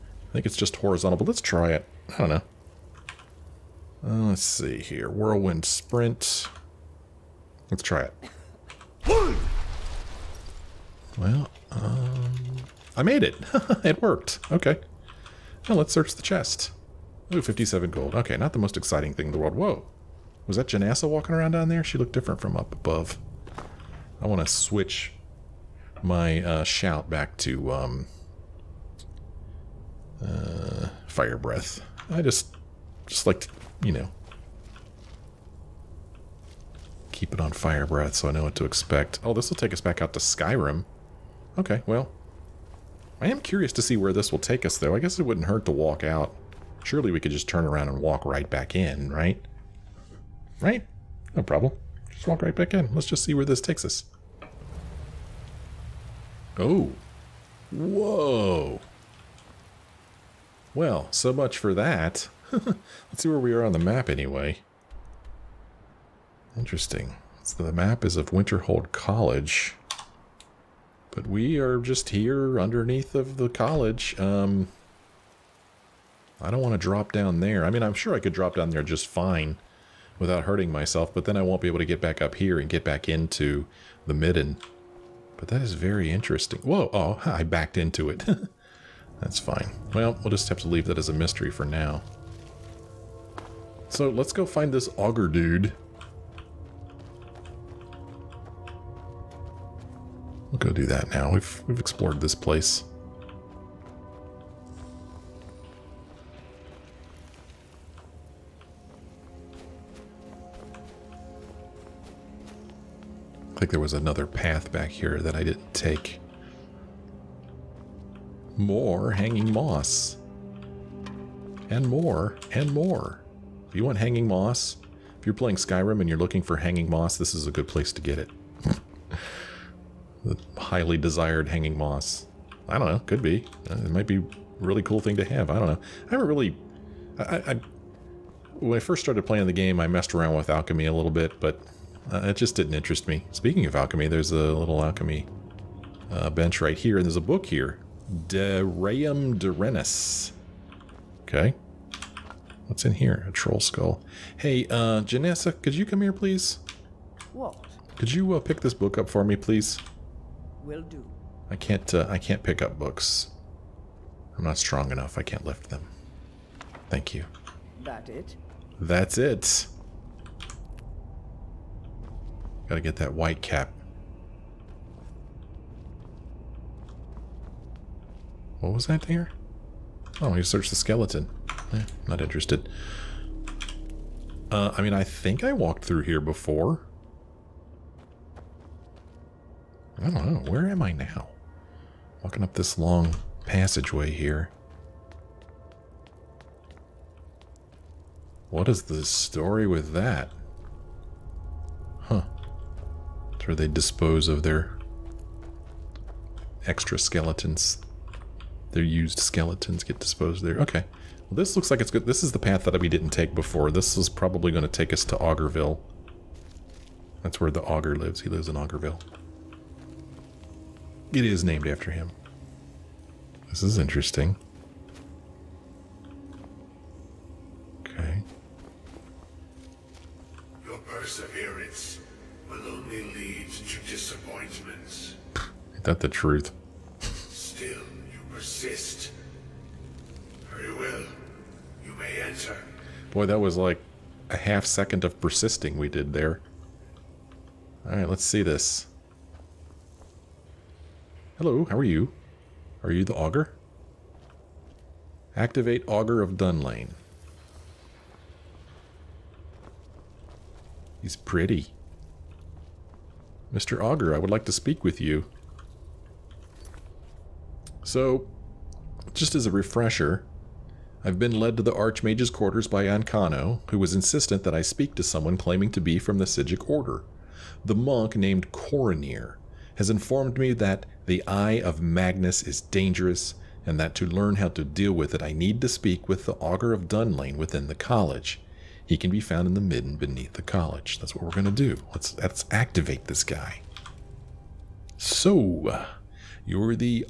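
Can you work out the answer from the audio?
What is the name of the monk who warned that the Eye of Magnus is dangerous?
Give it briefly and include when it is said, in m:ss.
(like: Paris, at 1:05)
Quaranir, at 4:38.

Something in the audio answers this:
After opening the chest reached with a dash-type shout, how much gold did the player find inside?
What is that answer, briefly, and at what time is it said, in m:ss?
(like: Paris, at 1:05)
57 gold, at 0:17.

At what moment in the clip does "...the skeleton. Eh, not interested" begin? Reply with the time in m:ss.
3:00.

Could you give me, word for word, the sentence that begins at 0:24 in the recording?
I want to switch my uh, shout back to um, uh, fire breath.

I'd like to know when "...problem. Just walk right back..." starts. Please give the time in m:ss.
0:51.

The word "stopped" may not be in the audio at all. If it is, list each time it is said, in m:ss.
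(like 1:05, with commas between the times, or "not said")
not said.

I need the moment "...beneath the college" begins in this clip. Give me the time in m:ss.
4:49.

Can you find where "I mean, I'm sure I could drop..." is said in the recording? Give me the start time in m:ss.
1:17.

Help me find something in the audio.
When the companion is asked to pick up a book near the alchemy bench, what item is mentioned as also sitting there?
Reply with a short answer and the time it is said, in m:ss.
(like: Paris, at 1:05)
Troll skull, at 2:33.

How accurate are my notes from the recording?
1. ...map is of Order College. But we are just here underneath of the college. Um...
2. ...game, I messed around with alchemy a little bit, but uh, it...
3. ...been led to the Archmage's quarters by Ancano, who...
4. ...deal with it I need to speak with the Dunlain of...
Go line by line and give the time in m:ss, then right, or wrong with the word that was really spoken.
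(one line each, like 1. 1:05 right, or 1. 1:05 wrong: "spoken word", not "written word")
1. 1:07 wrong: "Winterhold", not "Order"
2. 2:19 right
3. 4:31 right
4. 4:44 wrong: "Augur", not "Dunlain".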